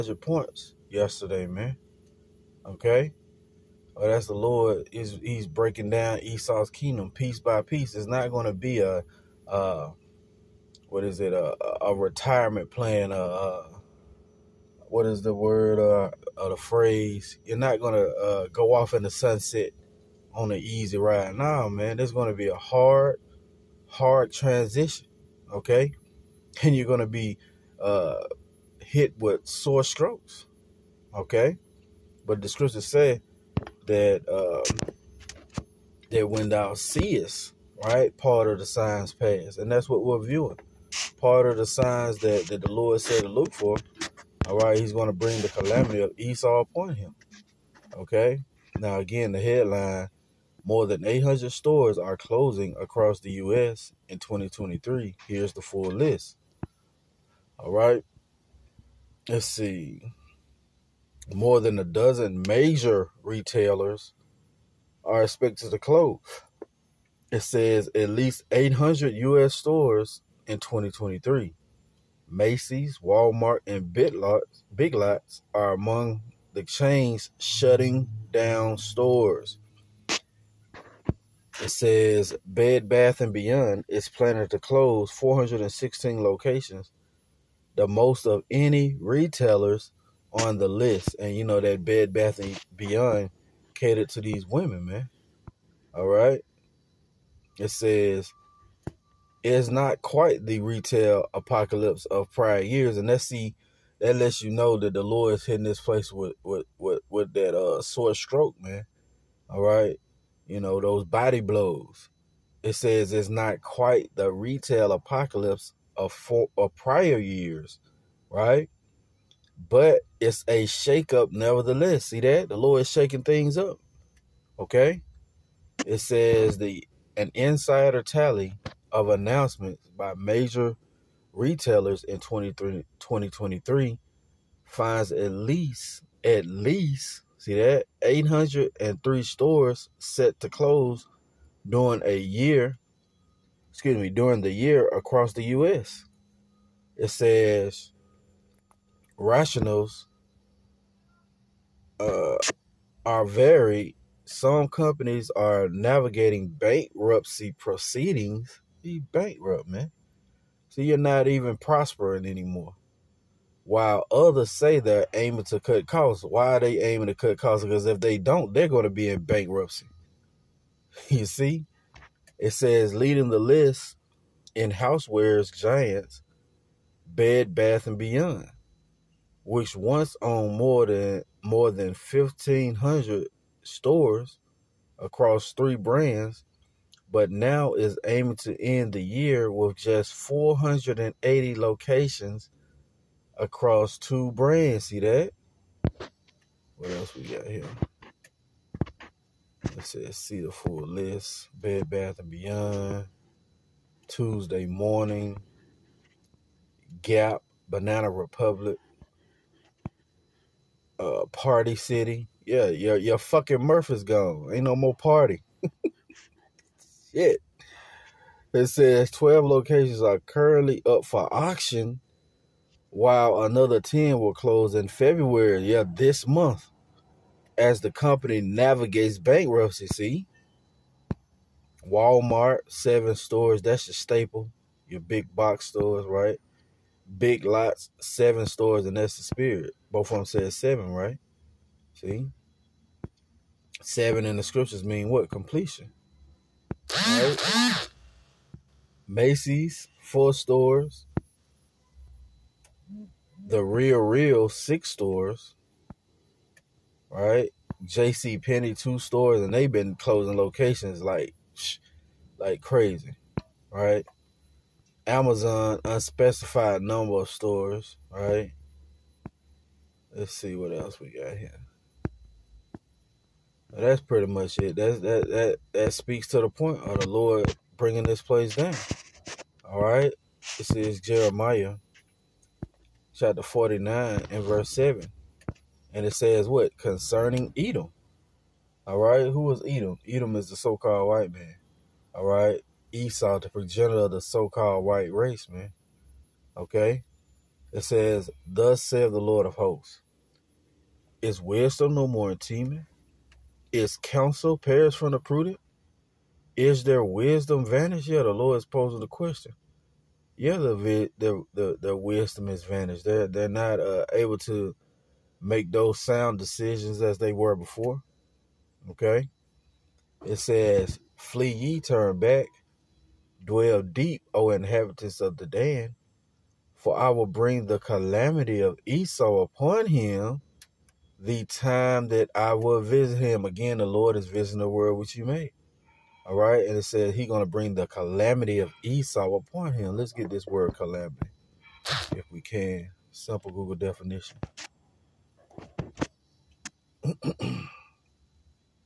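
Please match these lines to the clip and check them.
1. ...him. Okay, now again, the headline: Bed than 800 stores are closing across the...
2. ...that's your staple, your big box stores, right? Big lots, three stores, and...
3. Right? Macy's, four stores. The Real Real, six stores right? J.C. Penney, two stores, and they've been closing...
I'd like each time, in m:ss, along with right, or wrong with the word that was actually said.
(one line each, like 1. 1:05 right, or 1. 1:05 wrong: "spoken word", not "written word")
1. 0:46 wrong: "More", not "Bed"
2. 3:53 wrong: "seven", not "three"
3. 4:07 right.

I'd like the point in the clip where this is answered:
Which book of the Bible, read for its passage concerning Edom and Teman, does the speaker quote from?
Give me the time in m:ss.
4:41.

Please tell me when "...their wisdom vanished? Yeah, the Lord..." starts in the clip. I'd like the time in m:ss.
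5:06.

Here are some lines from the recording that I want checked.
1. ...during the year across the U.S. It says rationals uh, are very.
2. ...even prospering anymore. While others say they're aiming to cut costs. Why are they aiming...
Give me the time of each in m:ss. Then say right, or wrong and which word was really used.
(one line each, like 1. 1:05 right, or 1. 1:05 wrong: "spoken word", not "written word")
1. 2:24 right
2. 2:41 right.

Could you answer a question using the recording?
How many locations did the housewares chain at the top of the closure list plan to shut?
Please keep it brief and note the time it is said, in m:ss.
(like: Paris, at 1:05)
416, at 1:25.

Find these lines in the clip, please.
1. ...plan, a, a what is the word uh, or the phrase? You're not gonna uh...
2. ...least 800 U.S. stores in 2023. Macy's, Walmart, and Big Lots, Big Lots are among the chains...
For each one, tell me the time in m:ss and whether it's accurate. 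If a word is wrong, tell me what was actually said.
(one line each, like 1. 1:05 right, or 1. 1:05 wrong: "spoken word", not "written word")
1. 0:12 right
2. 1:08 right.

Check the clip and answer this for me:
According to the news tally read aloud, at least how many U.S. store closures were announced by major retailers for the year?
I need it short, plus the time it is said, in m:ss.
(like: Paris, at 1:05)
803, at 2:18.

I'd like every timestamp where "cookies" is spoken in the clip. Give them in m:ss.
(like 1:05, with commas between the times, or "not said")
not said.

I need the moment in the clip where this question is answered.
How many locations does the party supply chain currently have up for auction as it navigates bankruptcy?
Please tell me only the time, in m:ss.
3:39.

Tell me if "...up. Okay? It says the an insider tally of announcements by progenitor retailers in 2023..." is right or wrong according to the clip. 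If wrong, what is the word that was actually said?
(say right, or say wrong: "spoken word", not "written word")
wrong: "major", not "progenitor".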